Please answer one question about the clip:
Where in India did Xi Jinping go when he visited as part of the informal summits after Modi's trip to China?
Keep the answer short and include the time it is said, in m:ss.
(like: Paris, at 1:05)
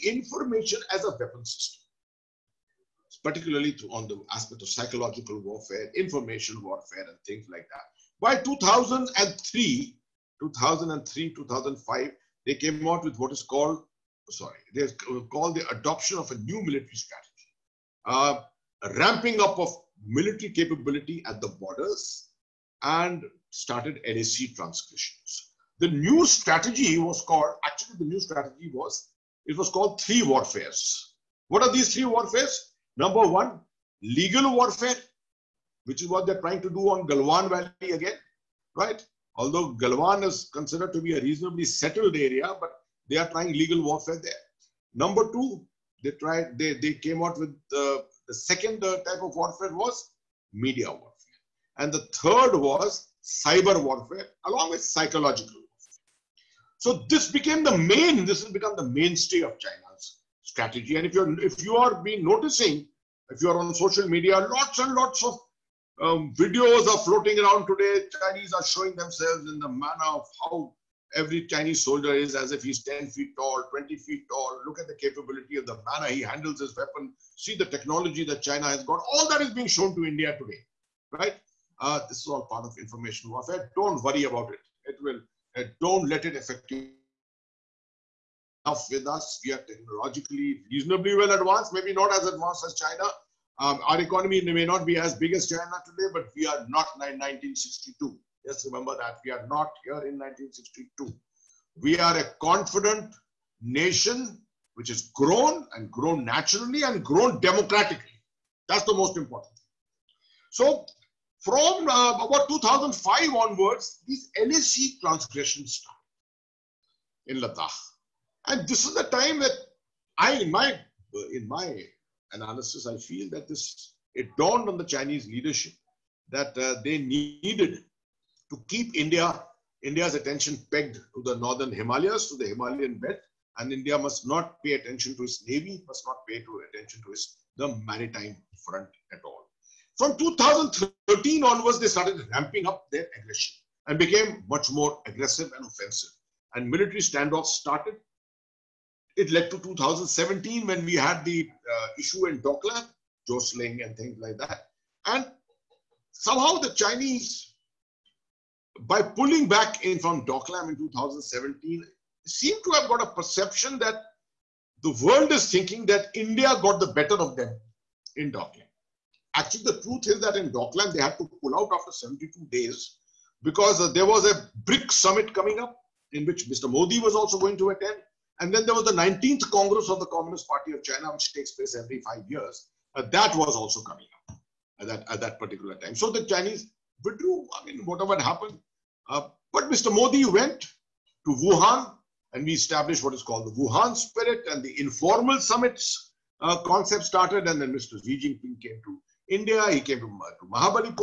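Mahabalipuram, at 3:20.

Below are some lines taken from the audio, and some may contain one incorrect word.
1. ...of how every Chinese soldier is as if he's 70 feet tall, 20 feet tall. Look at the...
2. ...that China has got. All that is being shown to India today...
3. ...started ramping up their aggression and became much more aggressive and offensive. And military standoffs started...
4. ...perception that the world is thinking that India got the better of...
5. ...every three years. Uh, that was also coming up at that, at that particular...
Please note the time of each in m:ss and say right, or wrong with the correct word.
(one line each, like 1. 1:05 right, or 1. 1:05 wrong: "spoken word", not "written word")
1. 1:10 wrong: "10", not "70"
2. 1:18 right
3. 2:21 right
4. 2:43 right
5. 3:01 wrong: "five", not "three".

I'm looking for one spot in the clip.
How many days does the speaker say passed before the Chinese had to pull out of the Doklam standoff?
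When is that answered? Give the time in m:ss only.
2:51.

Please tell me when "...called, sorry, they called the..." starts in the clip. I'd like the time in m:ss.
0:13.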